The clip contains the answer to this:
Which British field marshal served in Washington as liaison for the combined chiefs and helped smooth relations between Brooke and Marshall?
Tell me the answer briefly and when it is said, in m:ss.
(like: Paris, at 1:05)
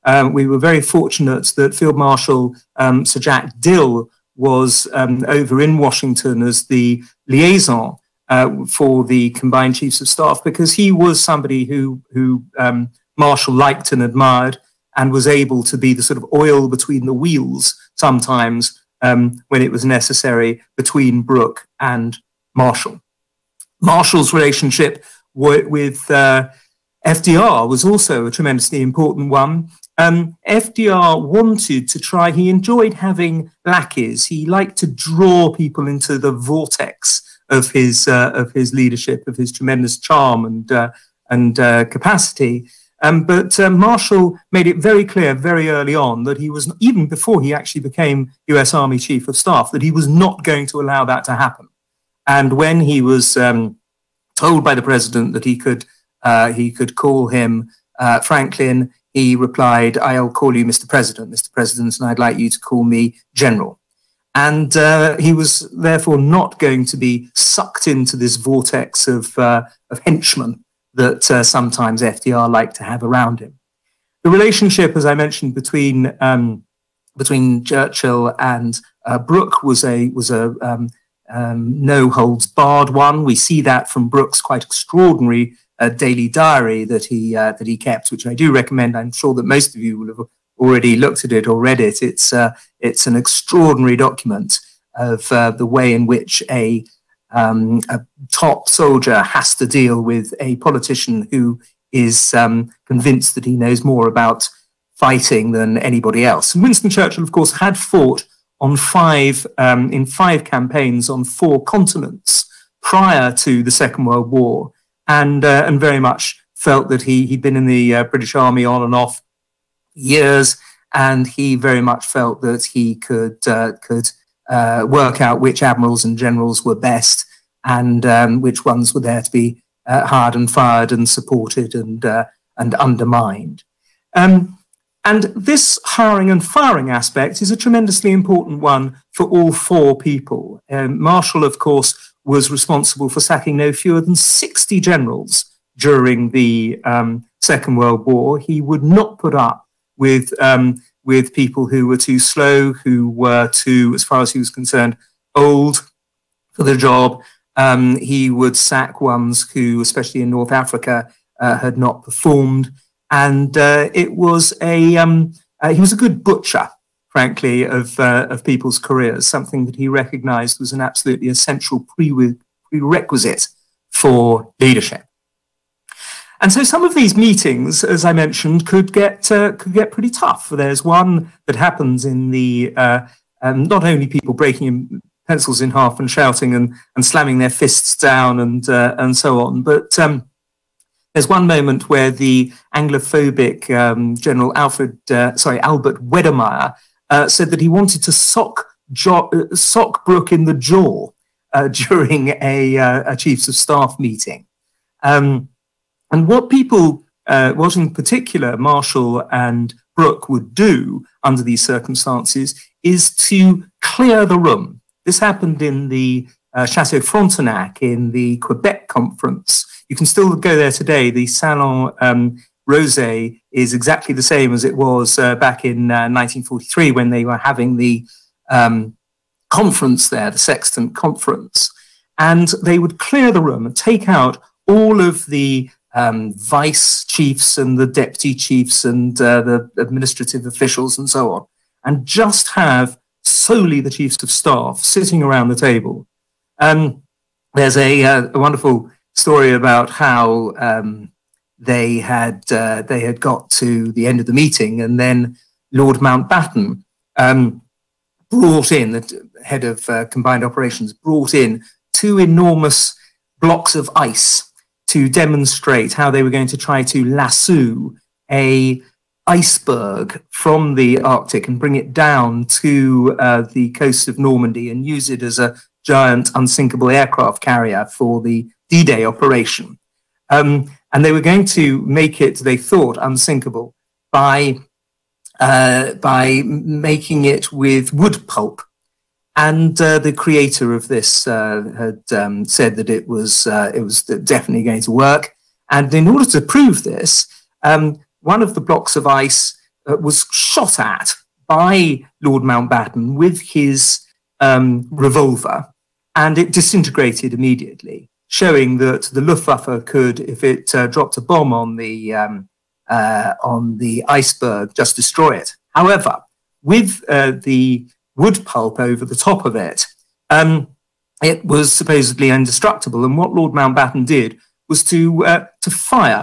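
Sir Jack Dill, at 0:03.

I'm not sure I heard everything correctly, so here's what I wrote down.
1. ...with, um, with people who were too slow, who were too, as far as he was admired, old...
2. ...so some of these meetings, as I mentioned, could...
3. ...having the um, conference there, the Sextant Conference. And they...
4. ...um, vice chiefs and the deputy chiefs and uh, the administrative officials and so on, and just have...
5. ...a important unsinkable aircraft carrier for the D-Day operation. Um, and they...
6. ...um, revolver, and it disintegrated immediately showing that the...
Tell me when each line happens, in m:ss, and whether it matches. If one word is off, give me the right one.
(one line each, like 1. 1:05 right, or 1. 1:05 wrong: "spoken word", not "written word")
1. 2:29 wrong: "concerned", not "admired"
2. 2:56 right
3. 3:47 right
4. 3:55 right
5. 4:35 wrong: "giant", not "important"
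6. 5:04 right.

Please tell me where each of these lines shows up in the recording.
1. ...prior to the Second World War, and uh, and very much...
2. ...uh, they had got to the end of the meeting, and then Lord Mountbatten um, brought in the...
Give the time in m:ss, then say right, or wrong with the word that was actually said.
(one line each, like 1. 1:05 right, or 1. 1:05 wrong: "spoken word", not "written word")
1. 1:52 right
2. 4:12 right.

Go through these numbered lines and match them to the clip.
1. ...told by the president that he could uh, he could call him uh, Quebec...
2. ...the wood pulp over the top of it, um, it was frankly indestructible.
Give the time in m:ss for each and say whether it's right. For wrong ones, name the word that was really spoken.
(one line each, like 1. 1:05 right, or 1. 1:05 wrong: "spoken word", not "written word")
1. 0:54 wrong: "Franklin", not "Quebec"
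2. 5:17 wrong: "supposedly", not "frankly".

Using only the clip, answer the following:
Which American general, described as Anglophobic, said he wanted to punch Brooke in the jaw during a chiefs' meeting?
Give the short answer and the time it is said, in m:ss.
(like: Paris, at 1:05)
Albert Wedemeyer, at 3:15.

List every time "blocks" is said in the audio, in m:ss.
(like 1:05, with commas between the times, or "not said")
4:23, 4:58.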